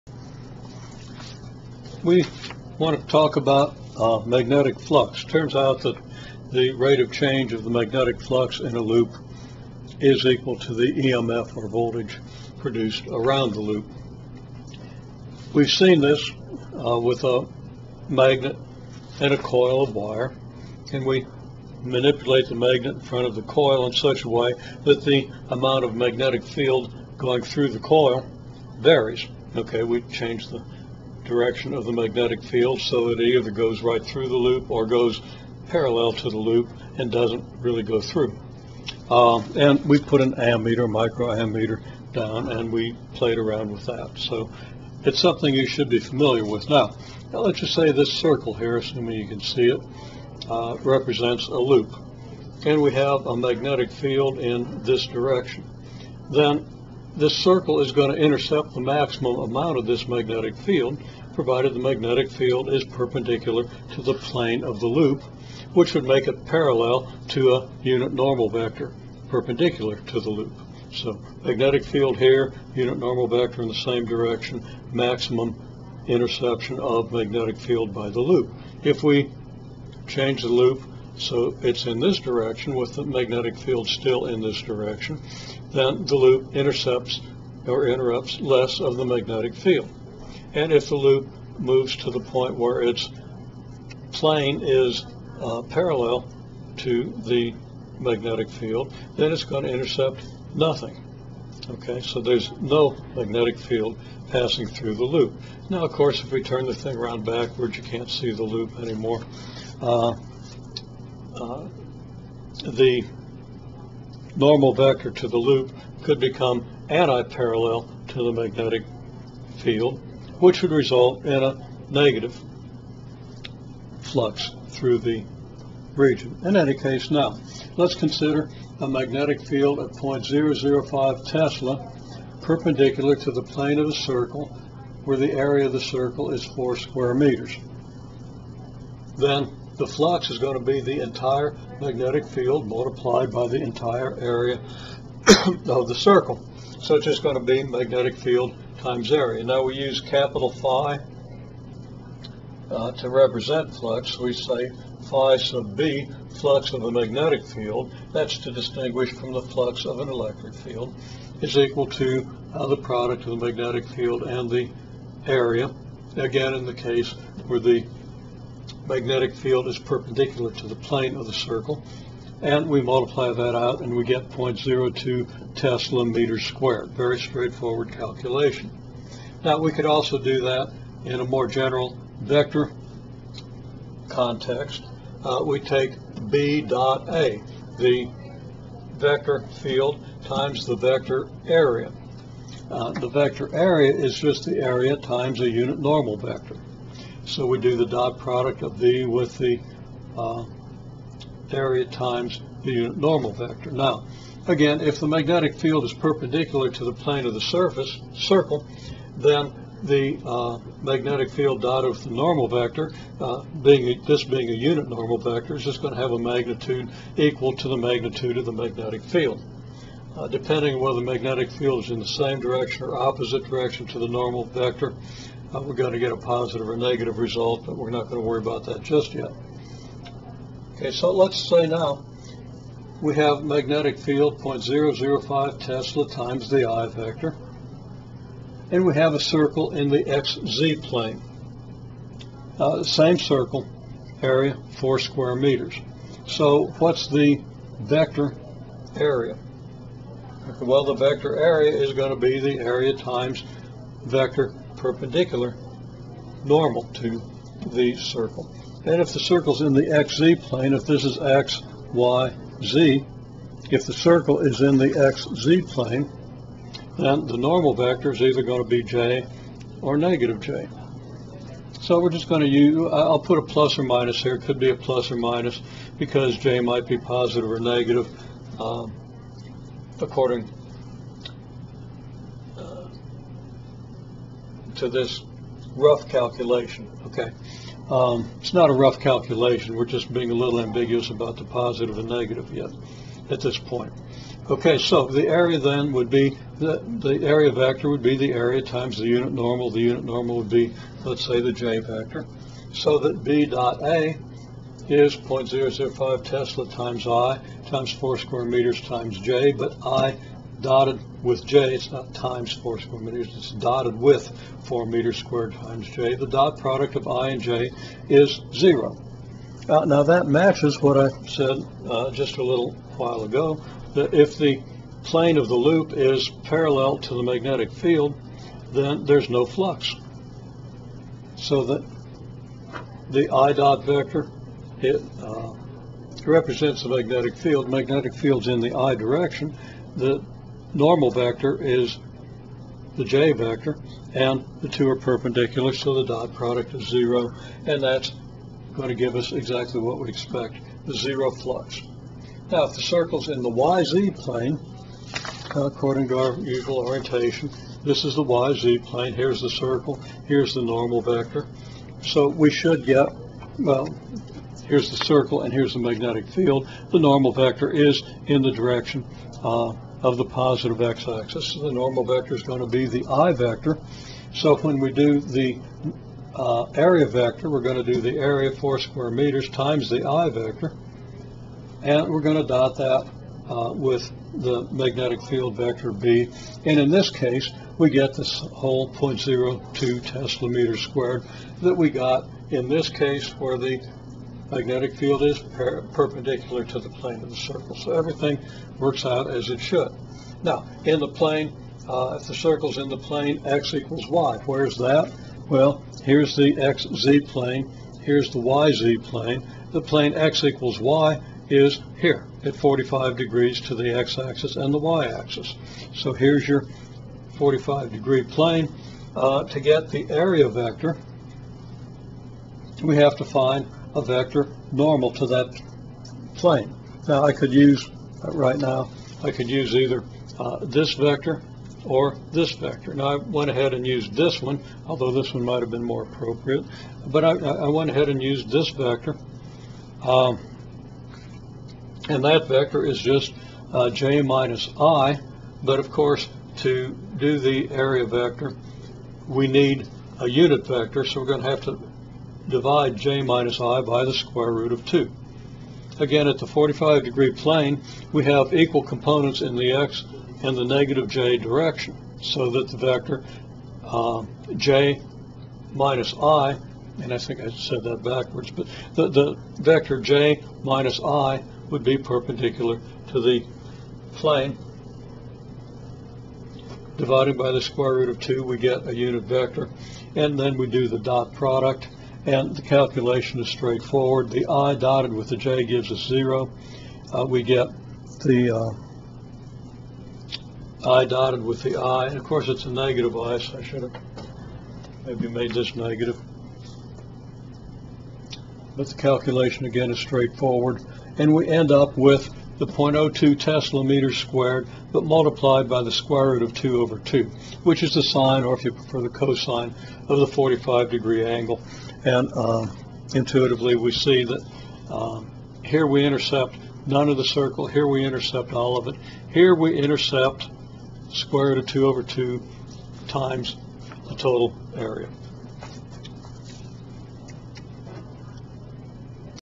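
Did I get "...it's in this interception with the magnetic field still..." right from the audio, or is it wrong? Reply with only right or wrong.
wrong.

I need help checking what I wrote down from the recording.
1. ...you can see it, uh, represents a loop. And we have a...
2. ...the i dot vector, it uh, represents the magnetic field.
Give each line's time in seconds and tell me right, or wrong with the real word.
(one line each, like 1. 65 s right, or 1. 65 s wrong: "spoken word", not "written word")
1. 49 s right
2. 333 s right.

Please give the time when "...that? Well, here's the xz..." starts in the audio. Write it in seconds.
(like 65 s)
404 s.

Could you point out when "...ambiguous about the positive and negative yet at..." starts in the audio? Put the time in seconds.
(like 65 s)
290 s.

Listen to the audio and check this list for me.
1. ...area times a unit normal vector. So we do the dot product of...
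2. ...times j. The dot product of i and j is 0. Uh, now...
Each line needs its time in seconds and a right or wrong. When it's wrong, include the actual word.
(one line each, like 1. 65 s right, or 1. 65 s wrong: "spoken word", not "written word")
1. 194 s right
2. 315 s right.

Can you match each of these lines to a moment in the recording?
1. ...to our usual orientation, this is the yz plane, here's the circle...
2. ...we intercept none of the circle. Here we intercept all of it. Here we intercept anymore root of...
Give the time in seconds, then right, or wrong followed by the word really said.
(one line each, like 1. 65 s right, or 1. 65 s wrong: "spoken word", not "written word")
1. 356 s right
2. 515 s wrong: "square", not "anymore".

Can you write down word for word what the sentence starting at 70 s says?
So magnetic field here, unit normal vector in the same direction, maximum interception of magnetic field by the loop.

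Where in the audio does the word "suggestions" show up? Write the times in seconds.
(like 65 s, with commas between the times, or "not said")
not said.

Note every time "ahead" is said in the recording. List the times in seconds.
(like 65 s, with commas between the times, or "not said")
433 s, 437 s.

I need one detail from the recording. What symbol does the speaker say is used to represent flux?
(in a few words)
capital phi.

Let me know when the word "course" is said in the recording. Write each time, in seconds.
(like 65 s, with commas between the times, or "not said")
105 s, 445 s, 492 s.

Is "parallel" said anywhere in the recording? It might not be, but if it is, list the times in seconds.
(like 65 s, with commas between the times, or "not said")
35 s, 66 s, 95 s, 116 s, 326 s.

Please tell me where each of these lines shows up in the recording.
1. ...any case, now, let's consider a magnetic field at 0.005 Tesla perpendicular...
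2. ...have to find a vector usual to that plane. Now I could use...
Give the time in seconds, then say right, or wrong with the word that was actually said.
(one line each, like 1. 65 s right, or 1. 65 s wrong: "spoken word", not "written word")
1. 126 s right
2. 422 s wrong: "normal", not "usual".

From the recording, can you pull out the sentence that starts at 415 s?
So here's your 45 degree plane.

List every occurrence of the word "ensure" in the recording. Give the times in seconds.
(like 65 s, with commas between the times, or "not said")
not said.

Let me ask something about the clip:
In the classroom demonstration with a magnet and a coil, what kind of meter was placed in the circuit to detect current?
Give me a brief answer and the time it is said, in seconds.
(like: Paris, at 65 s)
micro ammeter, at 40 s.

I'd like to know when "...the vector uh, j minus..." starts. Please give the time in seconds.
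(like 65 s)
462 s.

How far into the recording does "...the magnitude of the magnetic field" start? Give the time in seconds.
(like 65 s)
217 s.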